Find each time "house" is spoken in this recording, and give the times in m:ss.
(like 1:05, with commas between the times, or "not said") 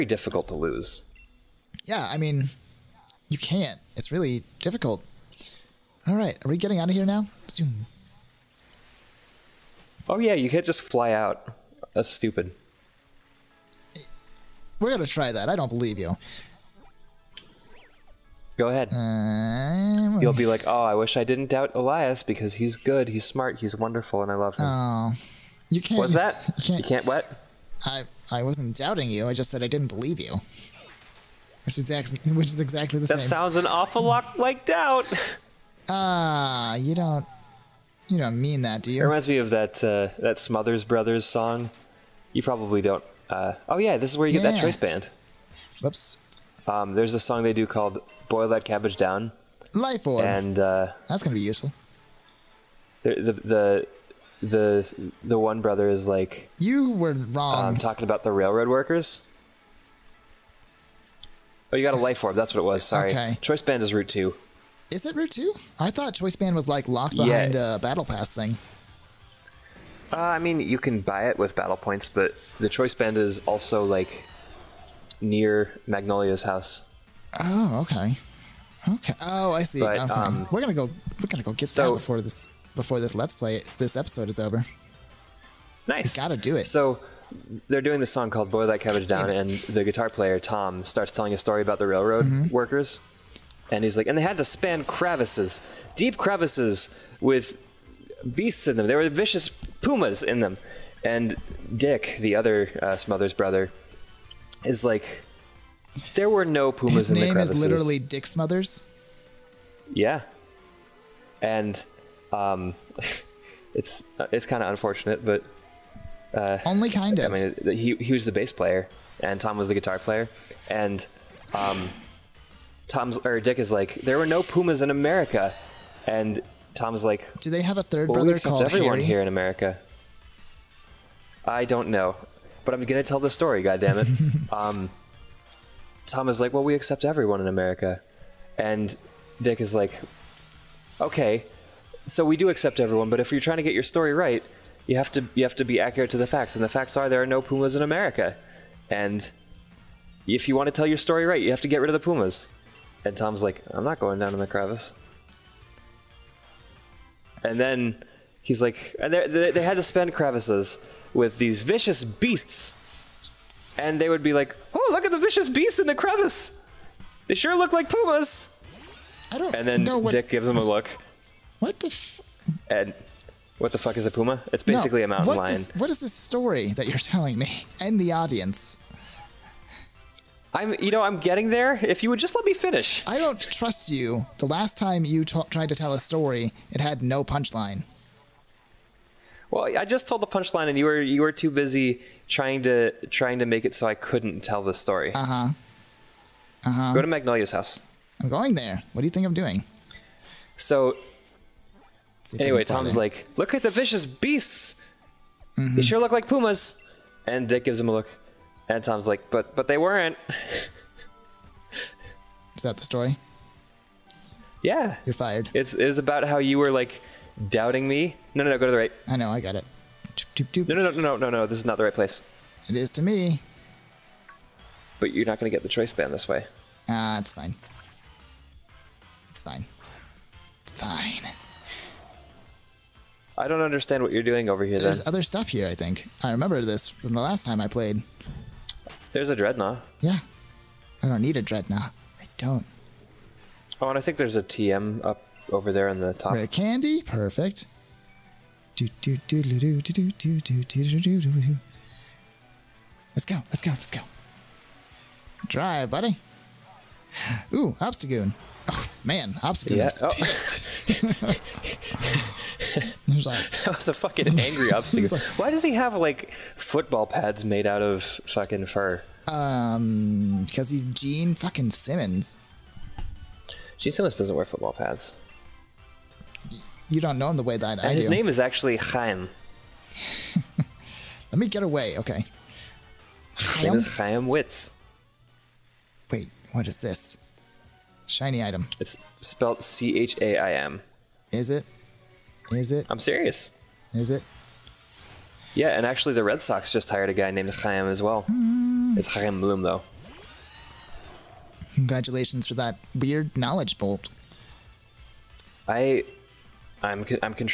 1:16, 3:17.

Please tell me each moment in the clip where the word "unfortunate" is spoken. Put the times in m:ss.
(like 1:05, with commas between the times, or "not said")
1:54.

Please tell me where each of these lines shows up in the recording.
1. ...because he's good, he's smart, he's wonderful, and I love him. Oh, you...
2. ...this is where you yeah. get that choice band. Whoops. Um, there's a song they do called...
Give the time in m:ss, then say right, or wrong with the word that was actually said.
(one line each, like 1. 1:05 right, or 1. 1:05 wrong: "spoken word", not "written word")
1. 0:22 right
2. 0:43 right.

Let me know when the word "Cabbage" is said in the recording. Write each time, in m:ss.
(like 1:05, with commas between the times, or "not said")
0:48, 1:28.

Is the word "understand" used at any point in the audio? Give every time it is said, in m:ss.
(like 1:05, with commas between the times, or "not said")
3:53.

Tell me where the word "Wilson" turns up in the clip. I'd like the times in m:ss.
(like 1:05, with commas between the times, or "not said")
not said.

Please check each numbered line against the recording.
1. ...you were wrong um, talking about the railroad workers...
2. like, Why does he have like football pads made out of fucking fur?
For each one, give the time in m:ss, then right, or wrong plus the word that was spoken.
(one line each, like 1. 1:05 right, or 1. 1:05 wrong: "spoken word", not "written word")
1. 0:56 right
2. 4:25 right.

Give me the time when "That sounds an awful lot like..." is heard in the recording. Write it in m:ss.
0:33.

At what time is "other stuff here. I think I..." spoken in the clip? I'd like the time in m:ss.
3:55.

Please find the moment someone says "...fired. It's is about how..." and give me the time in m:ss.
3:35.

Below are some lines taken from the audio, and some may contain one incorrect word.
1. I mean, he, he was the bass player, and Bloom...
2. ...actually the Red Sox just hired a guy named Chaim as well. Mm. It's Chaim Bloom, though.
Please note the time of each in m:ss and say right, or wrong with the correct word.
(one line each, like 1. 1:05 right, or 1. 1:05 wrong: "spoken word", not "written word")
1. 1:57 wrong: "Tom", not "Bloom"
2. 4:55 right.